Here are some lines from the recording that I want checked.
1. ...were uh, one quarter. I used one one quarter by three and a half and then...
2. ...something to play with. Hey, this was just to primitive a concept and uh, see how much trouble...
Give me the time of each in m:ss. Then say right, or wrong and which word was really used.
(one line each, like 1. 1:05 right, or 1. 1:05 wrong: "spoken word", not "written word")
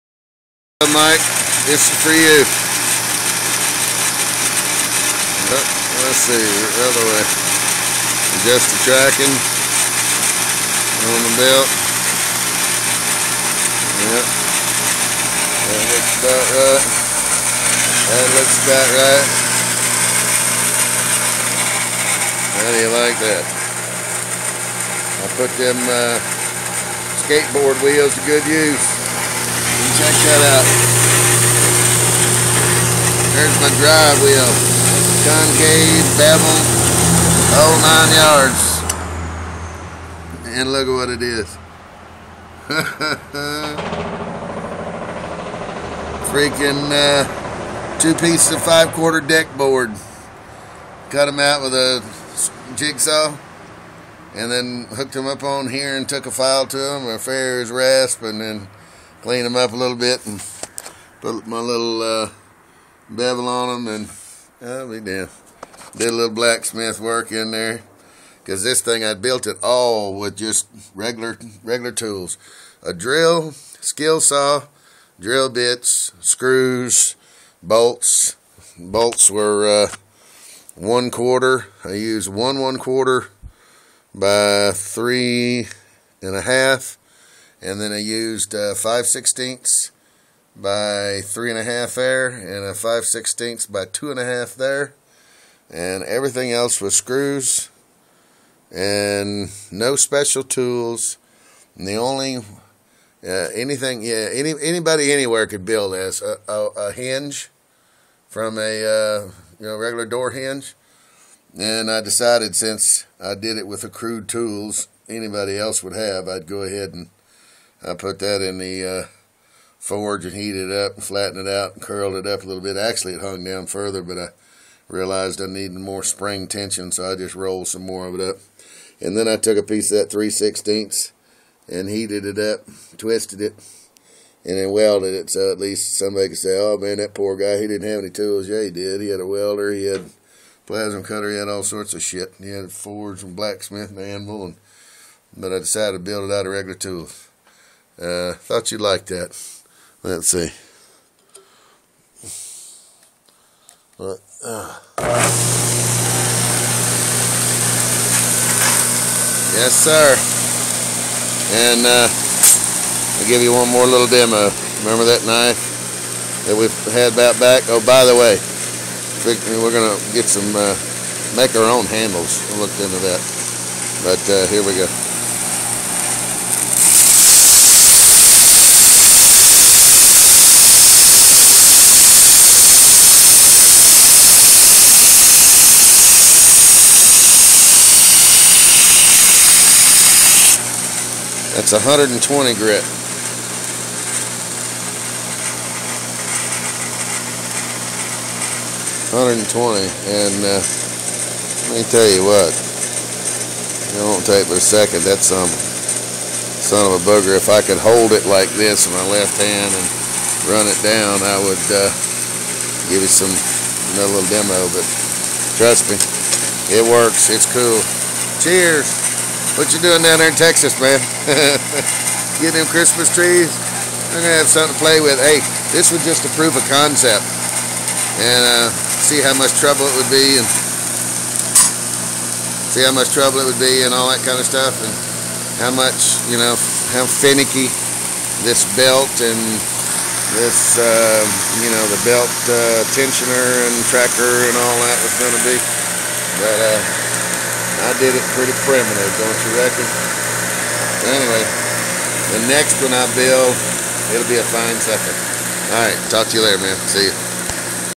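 1. 1:19 right
2. 3:44 wrong: "prove", not "primitive".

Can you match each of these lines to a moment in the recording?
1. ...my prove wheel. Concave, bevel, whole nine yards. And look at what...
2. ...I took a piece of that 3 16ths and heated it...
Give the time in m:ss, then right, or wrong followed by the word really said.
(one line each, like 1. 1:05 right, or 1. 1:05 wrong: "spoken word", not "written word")
1. 0:33 wrong: "drive", not "prove"
2. 2:09 right.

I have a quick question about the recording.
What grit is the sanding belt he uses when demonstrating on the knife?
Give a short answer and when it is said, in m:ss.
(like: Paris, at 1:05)
120 grit, at 3:11.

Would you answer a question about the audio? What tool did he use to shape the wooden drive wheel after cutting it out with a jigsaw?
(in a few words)
A farrier's rasp.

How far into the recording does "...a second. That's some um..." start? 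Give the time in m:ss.
3:24.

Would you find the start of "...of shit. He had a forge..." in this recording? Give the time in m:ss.
2:21.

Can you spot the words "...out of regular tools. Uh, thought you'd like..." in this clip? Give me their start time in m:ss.
2:26.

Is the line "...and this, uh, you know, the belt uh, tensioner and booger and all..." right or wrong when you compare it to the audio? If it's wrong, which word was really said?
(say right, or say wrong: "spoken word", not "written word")
wrong: "tracker", not "booger".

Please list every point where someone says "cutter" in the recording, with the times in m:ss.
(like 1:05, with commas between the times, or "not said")
2:21.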